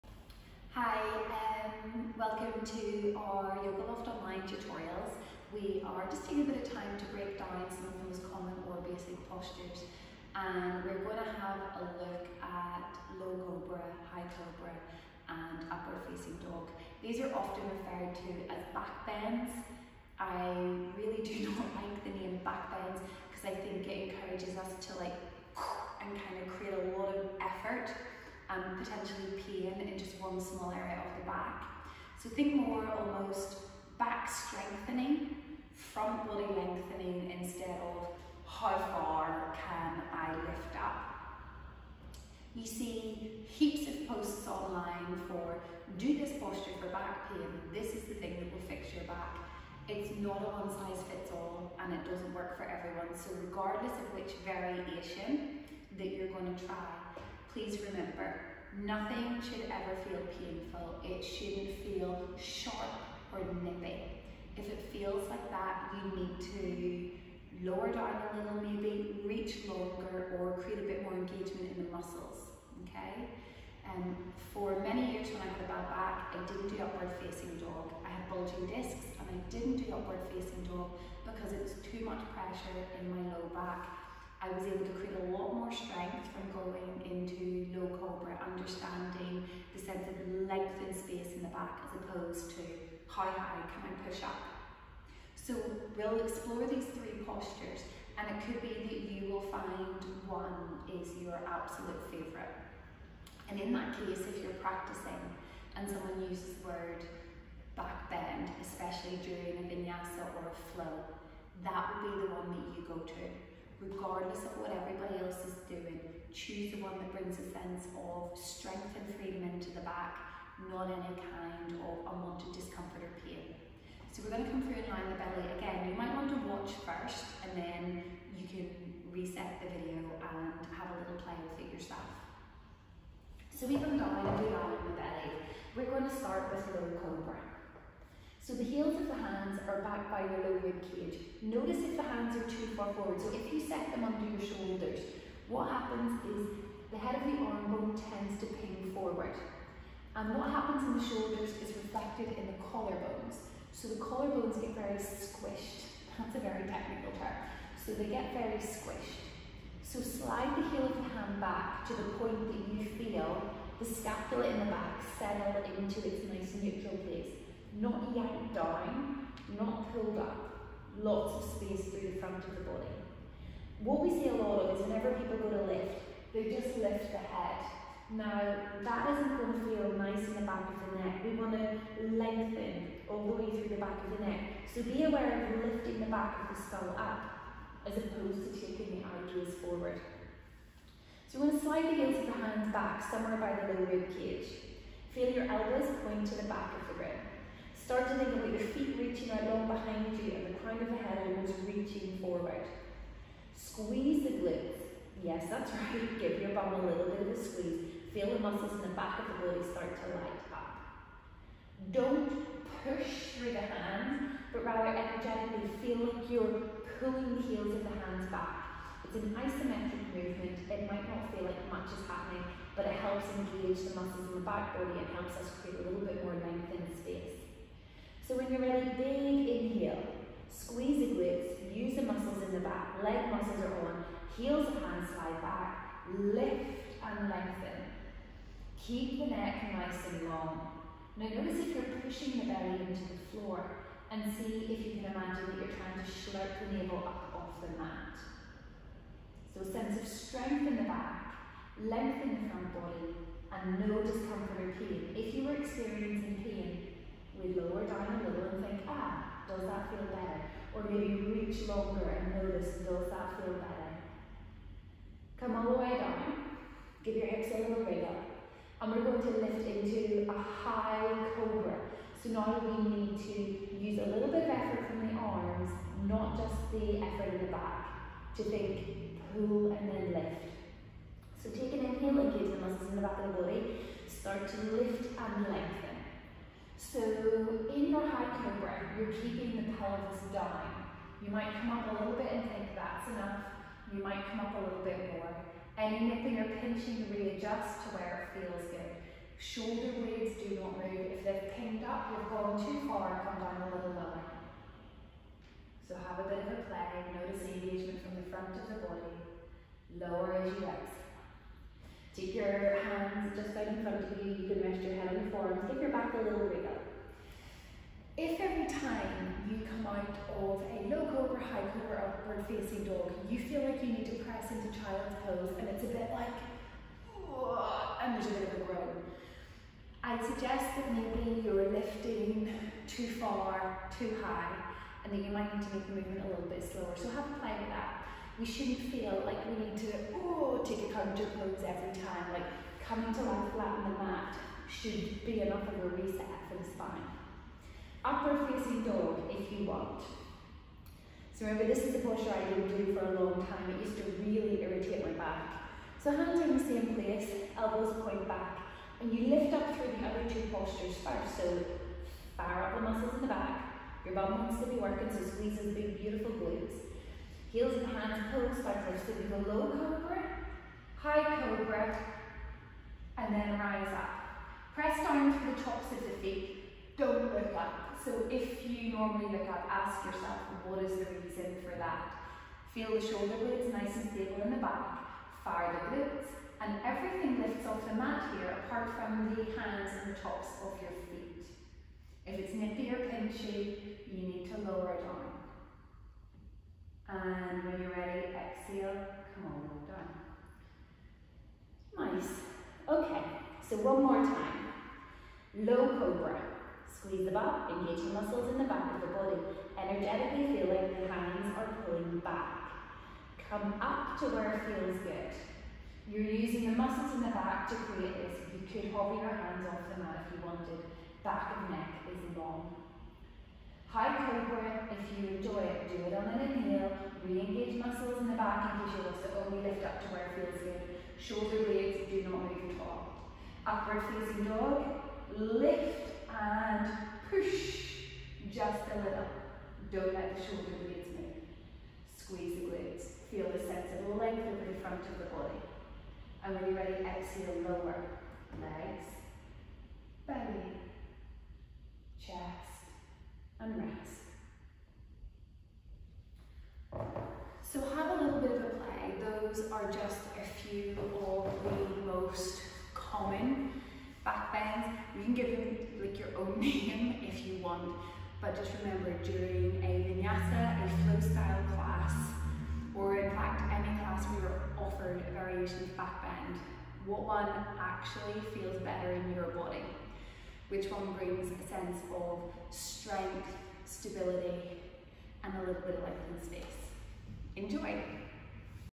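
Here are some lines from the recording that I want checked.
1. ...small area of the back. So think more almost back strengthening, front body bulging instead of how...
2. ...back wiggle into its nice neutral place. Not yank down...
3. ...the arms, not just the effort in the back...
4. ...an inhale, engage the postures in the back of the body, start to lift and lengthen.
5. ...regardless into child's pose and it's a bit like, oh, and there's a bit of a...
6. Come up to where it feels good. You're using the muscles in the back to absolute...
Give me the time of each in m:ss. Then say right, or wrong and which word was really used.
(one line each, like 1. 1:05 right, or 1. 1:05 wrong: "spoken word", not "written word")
1. 0:30 wrong: "lengthening", not "bulging"
2. 2:44 wrong: "settle", not "wiggle"
3. 4:35 right
4. 4:41 wrong: "muscles", not "postures"
5. 5:24 wrong: "press", not "regardless"
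6. 6:53 wrong: "create", not "absolute".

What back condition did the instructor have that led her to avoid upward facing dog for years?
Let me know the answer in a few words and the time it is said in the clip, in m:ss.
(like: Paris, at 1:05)
bulging discs, at 1:18.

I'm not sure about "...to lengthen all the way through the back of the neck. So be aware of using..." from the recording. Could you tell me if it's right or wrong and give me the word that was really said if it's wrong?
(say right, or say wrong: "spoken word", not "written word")
wrong: "lifting", not "using".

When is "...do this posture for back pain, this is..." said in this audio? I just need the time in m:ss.
0:45.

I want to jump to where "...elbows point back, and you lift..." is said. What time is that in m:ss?
5:57.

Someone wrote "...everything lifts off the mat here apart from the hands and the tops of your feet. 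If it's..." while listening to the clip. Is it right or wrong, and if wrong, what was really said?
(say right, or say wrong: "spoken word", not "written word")
right.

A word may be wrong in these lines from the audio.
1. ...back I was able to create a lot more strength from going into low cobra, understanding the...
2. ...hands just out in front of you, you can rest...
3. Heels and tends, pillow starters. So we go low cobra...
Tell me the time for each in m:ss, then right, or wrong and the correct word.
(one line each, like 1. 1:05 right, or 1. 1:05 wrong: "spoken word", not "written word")
1. 1:23 right
2. 5:12 right
3. 6:07 wrong: "hands", not "tends".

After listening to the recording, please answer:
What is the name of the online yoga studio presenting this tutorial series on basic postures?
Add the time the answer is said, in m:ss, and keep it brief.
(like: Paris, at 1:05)
Yoga Loft Online, at 0:03.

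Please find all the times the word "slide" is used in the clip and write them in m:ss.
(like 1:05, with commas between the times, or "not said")
2:40, 3:11.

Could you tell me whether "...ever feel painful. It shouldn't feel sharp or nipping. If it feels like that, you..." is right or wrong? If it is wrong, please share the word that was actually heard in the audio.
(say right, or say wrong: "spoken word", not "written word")
right.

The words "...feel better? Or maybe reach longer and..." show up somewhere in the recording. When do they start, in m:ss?
4:19.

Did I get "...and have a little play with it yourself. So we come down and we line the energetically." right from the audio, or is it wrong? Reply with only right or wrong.
wrong.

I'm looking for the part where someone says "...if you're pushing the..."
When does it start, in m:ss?
4:01.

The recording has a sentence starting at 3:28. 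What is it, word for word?
Feel the muscles in the back of the body start to light up.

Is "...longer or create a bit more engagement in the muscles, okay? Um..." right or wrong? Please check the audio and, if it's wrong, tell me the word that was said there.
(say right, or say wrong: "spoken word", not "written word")
right.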